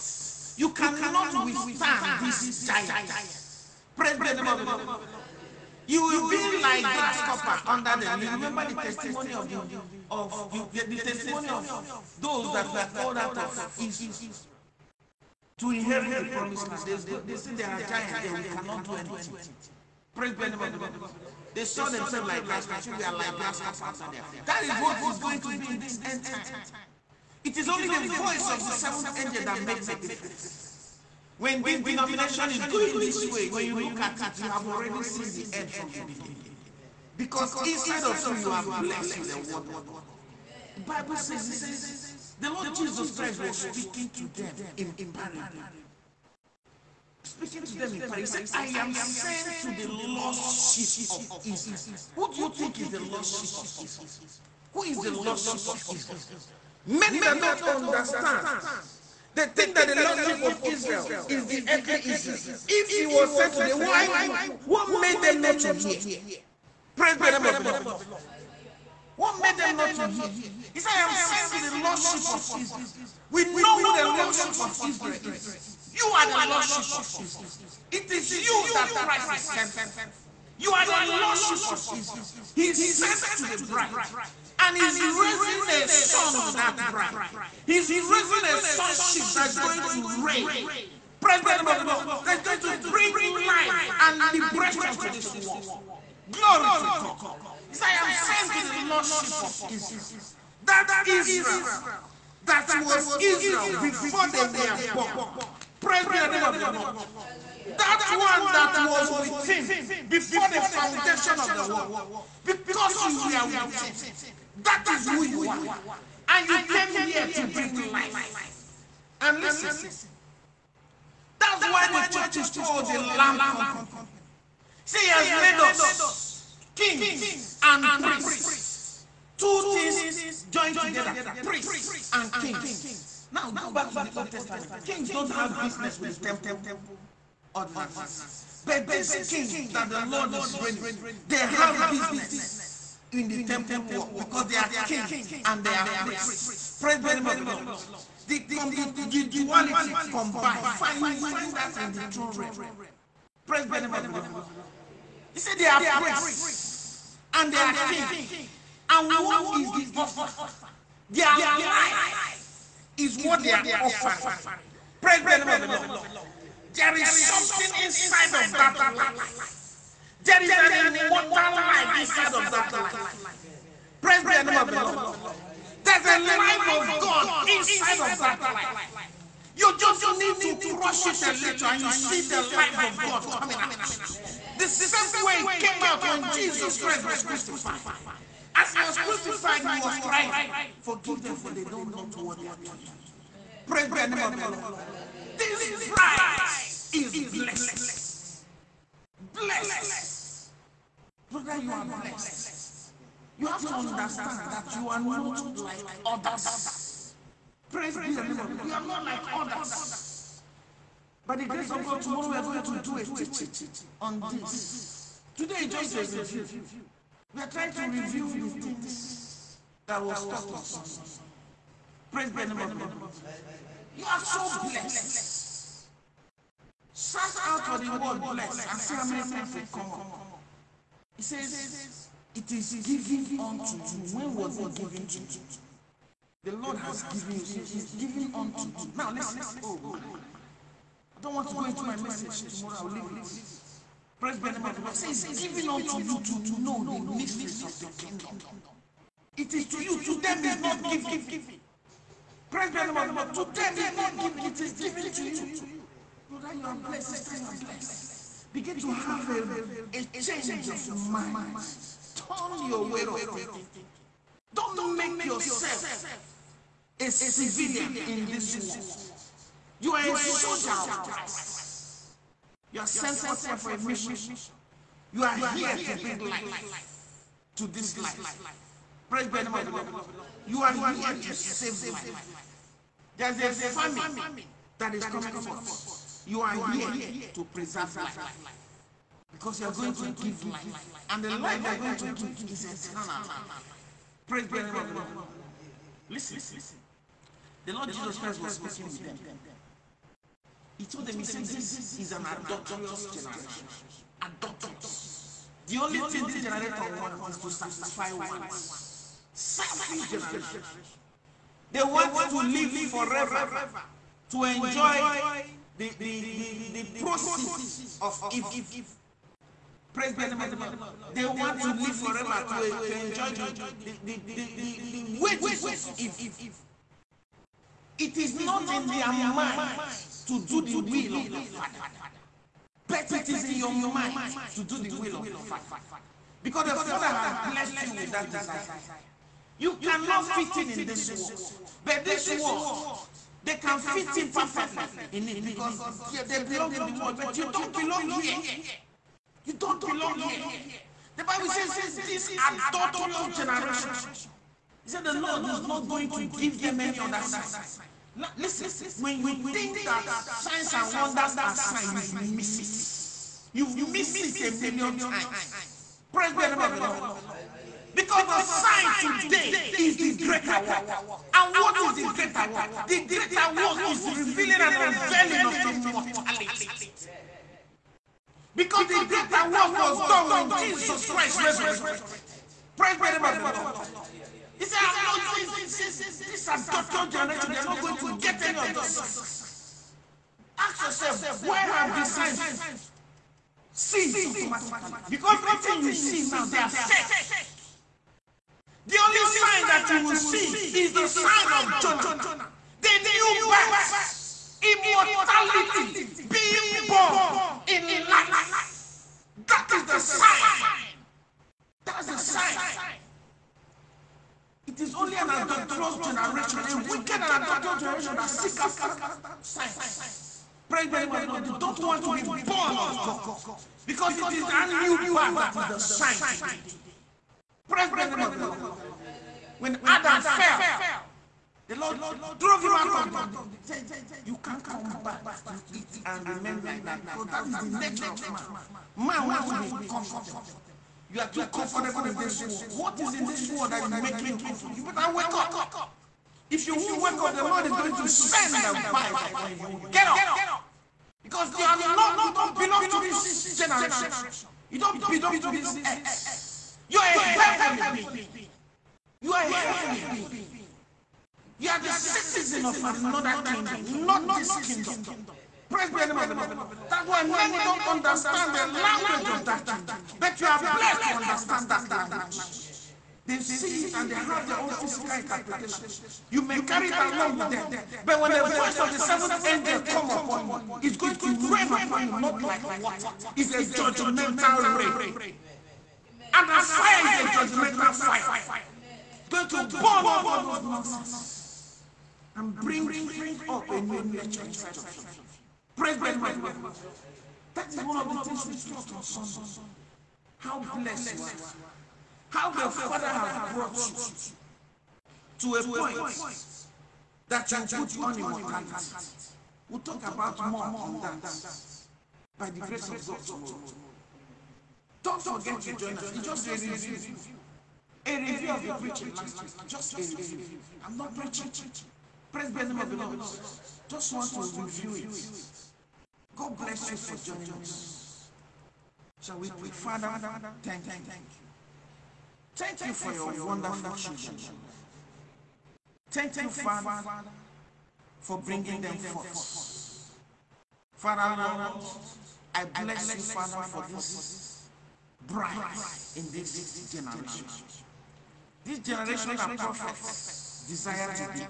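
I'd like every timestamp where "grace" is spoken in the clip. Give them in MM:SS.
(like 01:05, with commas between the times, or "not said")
03:31, 08:32.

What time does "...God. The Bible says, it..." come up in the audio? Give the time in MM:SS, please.
00:39.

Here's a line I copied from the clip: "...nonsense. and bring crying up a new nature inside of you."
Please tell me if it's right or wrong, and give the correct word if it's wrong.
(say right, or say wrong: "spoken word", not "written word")
wrong: "spring", not "crying".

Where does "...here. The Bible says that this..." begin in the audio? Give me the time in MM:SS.
05:50.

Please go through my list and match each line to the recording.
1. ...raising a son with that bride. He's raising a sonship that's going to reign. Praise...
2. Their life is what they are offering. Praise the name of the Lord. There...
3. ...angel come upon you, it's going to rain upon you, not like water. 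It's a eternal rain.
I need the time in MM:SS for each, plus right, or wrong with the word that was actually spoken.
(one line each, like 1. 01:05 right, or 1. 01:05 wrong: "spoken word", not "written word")
1. 01:25 right
2. 02:41 right
3. 07:59 wrong: "judgmental", not "eternal".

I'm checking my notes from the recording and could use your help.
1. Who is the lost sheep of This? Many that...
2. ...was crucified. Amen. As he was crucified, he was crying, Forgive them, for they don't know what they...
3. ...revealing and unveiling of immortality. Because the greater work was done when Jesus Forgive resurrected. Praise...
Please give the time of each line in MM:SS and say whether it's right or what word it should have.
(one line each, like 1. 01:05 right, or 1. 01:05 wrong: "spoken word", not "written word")
1. 00:54 wrong: "Israel", not "This"
2. 03:07 right
3. 06:14 wrong: "Christ", not "Forgive".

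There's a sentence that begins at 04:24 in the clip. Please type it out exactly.
Don't make yourself a civilian in this world.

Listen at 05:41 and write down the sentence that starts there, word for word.
But this world, they can fit in perfectly in it because they belong to the world.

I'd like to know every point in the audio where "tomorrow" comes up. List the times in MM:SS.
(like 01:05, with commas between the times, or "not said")
03:32, 04:02, 08:33.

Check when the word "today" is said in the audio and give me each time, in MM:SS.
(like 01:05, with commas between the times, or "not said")
01:03, 03:35, 06:08, 07:06.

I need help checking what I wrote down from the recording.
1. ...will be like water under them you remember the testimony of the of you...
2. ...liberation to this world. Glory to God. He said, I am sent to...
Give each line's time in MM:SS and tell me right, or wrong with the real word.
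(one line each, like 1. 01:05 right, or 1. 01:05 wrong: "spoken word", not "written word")
1. 00:06 wrong: "grasshopper", not "water"
2. 01:34 right.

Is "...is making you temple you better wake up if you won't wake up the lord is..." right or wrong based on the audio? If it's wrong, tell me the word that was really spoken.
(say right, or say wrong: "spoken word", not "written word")
wrong: "comfortable", not "temple".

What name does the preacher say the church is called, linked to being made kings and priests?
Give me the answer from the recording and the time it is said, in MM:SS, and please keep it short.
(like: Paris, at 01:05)
the Lamb Company, at 02:02.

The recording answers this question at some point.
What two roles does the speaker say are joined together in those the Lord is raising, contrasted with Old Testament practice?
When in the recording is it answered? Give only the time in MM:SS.
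02:09.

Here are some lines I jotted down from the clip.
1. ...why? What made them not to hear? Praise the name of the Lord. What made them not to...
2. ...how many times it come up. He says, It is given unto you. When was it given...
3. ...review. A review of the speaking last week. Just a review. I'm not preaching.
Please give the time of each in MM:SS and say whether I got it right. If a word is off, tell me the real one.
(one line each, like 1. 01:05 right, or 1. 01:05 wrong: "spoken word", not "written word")
1. 01:03 right
2. 03:48 right
3. 08:36 wrong: "preaching", not "speaking".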